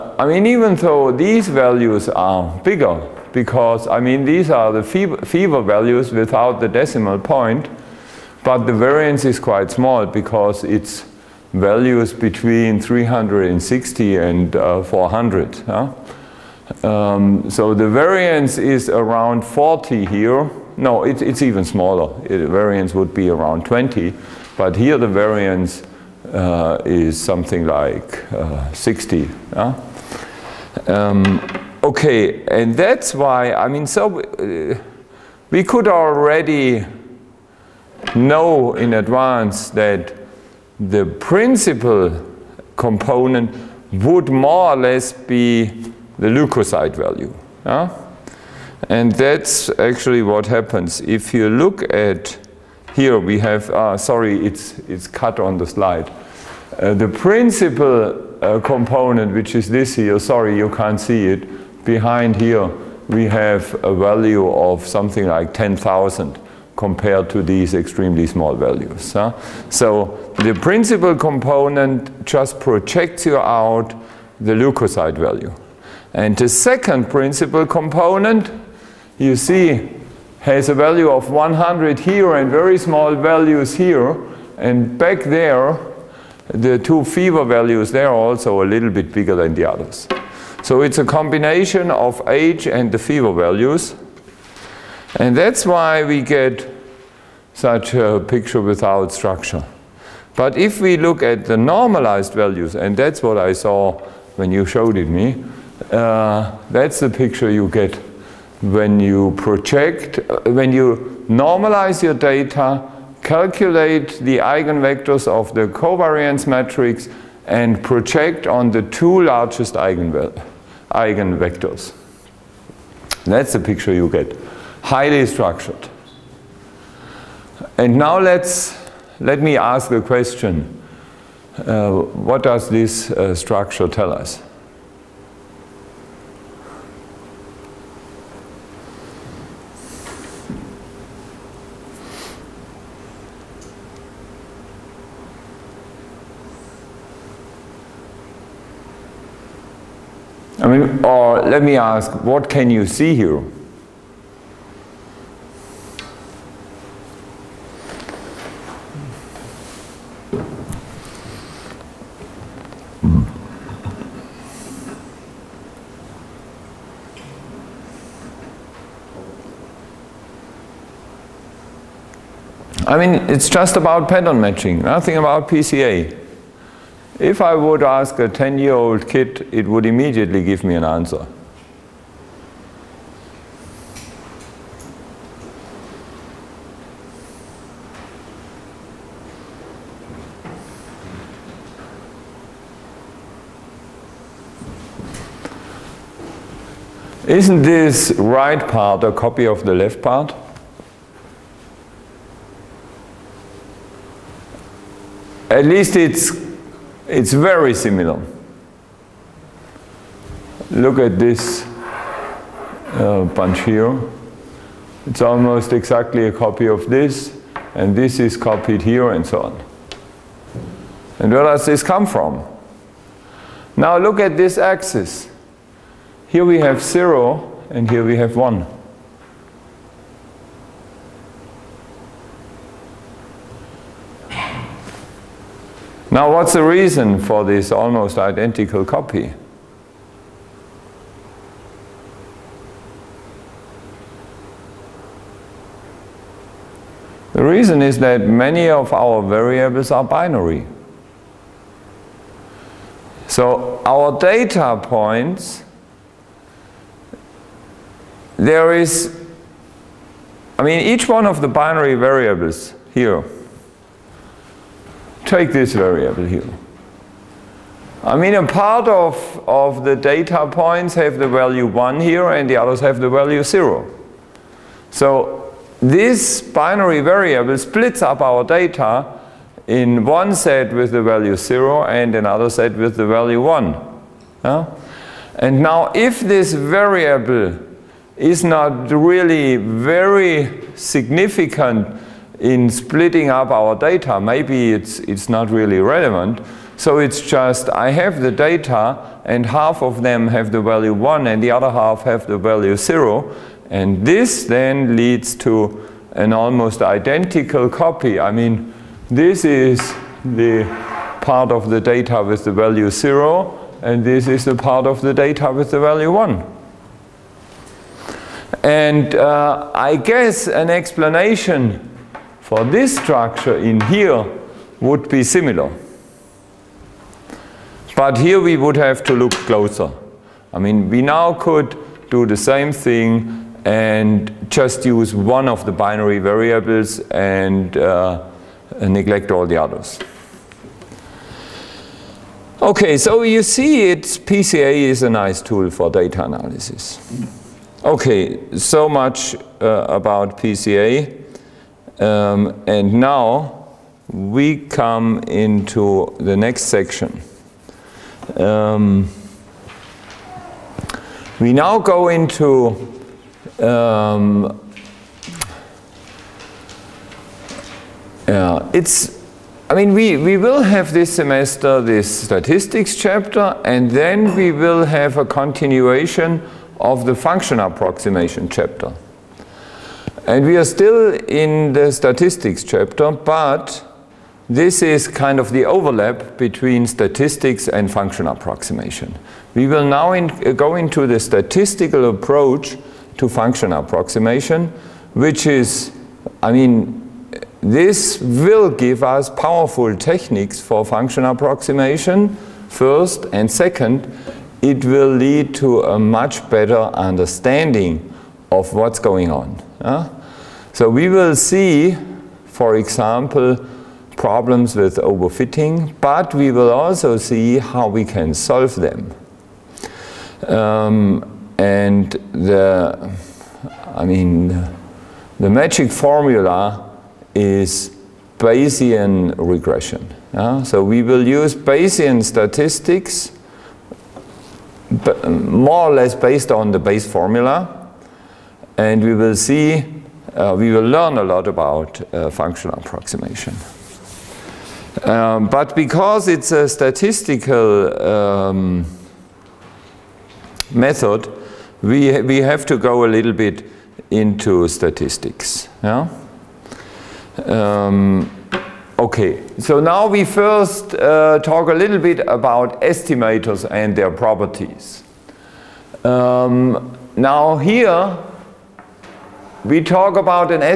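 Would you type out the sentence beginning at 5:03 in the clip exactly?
And this then leads to an almost identical copy.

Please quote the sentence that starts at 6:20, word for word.
And we are still in the statistics chapter, but this is kind of the overlap between statistics and function approximation.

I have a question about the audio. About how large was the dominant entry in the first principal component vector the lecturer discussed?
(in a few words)
10,000.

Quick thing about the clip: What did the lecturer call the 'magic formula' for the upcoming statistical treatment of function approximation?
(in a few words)
Bayesian regression.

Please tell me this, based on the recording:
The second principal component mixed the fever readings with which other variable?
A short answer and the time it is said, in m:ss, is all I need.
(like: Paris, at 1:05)
age, at 1:32.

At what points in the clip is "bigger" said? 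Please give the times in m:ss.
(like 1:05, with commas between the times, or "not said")
0:02, 1:29.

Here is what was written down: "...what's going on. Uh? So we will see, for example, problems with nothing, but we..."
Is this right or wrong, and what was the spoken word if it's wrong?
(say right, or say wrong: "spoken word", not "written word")
wrong: "overfitting", not "nothing".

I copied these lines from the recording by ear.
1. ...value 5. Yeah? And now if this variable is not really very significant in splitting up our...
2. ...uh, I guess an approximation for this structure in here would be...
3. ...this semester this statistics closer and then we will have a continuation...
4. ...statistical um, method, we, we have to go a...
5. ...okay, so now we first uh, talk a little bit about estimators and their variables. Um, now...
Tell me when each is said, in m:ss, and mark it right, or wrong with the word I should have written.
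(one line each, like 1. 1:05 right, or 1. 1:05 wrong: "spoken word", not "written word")
1. 4:43 wrong: "1", not "5"
2. 5:19 wrong: "explanation", not "approximation"
3. 6:10 wrong: "chapter", not "closer"
4. 7:26 right
5. 7:38 wrong: "properties", not "variables".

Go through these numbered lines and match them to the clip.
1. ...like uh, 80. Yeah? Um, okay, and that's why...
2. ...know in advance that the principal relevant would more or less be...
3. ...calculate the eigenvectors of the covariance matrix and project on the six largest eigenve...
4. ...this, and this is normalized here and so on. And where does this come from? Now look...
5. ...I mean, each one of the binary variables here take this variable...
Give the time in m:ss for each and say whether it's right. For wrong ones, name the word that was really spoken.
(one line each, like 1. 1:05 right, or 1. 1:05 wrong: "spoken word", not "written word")
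1. 0:27 wrong: "60", not "80"
2. 0:38 wrong: "component", not "relevant"
3. 1:53 wrong: "two", not "six"
4. 3:36 wrong: "copied", not "normalized"
5. 4:20 right.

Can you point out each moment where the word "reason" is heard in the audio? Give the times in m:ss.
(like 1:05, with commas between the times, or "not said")
3:56, 4:07.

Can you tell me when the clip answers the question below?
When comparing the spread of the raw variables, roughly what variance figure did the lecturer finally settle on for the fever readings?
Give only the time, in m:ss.
0:23.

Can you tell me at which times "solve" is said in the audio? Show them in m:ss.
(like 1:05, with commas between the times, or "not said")
6:58.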